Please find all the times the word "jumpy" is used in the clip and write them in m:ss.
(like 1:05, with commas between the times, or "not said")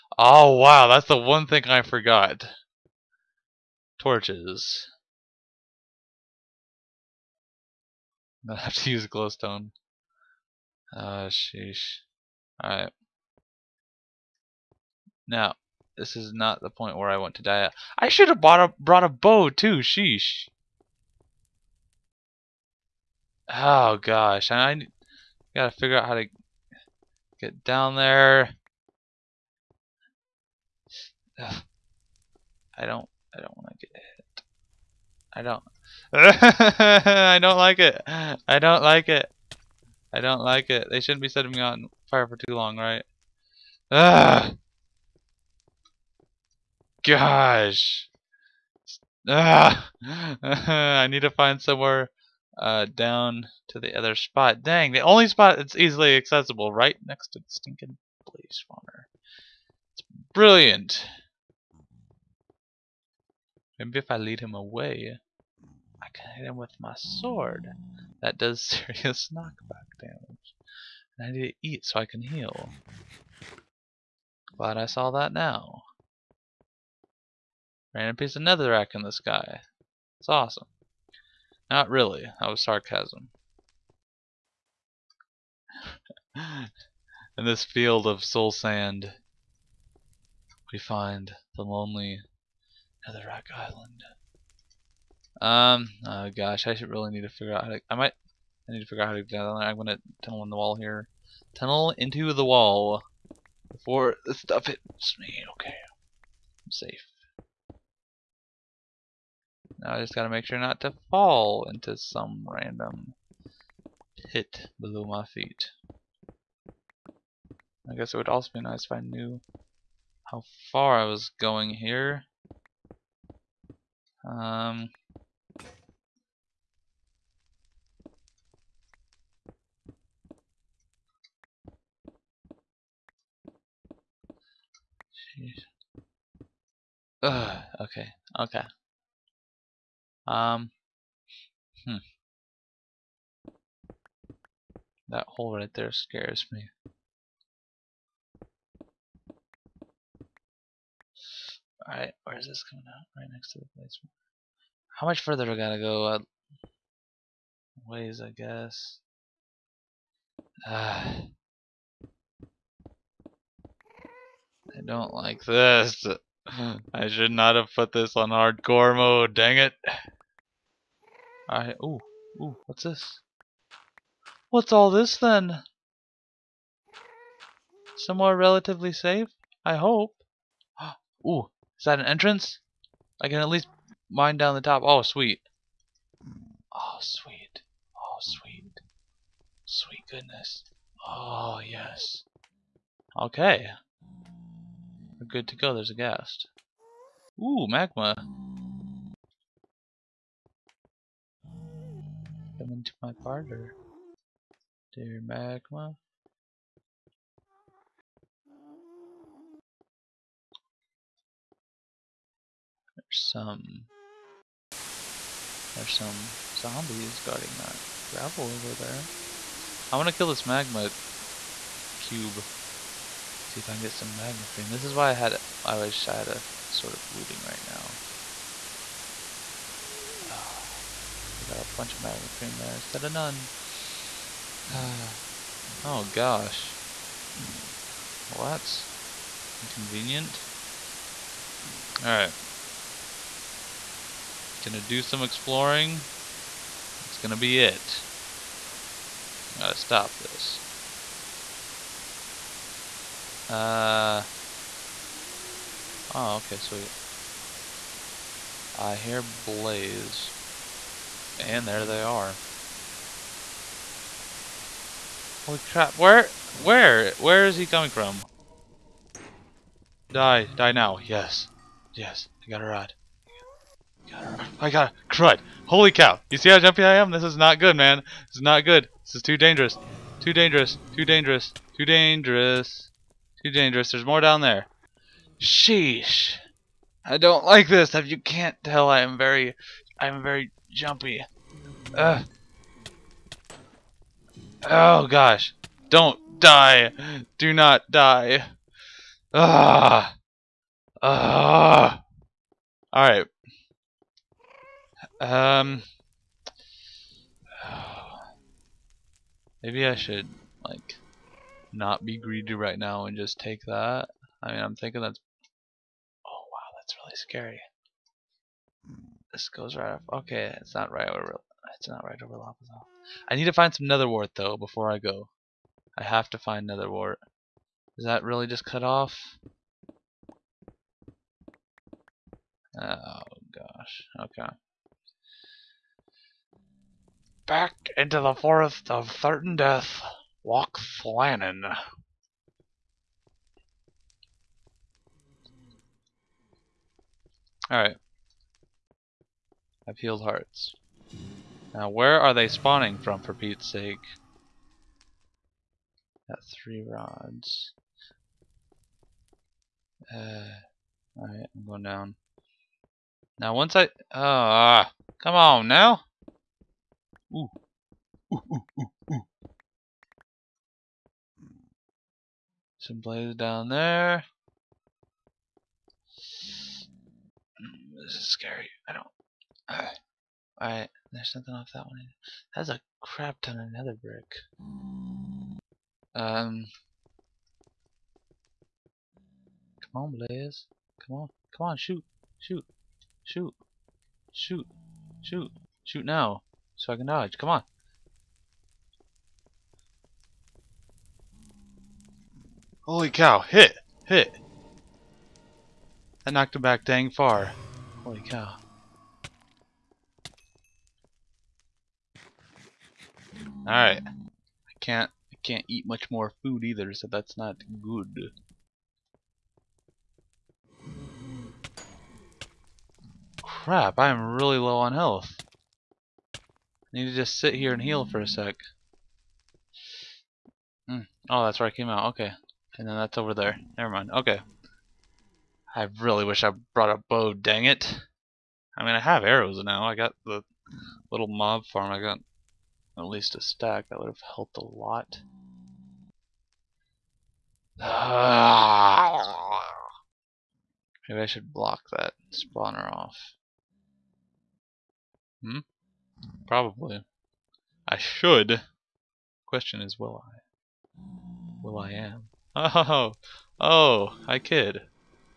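4:36, 4:50.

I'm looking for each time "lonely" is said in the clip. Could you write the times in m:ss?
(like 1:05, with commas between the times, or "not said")
1:31.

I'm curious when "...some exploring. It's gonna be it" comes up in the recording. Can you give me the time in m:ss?
4:05.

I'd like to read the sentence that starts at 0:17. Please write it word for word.
I should have bought a, brought a bow too, sheesh.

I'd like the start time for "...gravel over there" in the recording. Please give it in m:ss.
3:38.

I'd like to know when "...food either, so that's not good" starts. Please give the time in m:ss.
6:56.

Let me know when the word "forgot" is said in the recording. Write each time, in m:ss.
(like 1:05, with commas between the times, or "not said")
0:01.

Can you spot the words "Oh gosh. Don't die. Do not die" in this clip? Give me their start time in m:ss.
4:54.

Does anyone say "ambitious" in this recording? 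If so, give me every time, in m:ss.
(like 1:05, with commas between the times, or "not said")
not said.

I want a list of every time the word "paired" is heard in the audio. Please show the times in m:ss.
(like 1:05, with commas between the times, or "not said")
not said.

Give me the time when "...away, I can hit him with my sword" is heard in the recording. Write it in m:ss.
1:04.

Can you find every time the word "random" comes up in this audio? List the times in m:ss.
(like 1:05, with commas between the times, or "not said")
1:17, 1:52.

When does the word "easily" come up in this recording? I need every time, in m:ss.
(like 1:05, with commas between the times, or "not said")
0:55.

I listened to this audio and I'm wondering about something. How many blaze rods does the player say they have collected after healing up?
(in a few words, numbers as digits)
3.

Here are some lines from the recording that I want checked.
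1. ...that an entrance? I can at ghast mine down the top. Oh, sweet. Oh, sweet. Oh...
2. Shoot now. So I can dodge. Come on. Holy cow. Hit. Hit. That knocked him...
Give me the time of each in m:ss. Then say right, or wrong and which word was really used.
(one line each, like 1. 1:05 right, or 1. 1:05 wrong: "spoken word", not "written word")
1. 3:01 wrong: "least", not "ghast"
2. 6:35 right.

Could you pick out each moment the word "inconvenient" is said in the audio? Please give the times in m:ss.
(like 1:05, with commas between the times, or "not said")
3:59.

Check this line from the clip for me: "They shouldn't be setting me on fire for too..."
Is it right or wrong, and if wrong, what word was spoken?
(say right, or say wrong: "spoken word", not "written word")
right.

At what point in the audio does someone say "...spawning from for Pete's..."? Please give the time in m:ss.
5:52.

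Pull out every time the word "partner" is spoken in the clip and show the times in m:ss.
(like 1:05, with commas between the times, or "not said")
3:23.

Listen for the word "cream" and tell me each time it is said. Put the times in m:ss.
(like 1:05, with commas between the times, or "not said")
3:44, 3:52.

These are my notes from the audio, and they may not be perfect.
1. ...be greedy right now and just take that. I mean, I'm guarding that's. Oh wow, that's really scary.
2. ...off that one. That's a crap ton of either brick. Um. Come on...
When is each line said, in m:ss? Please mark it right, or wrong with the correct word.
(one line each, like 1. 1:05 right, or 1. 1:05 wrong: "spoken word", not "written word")
1. 5:12 wrong: "thinking", not "guarding"
2. 6:21 wrong: "nether", not "either".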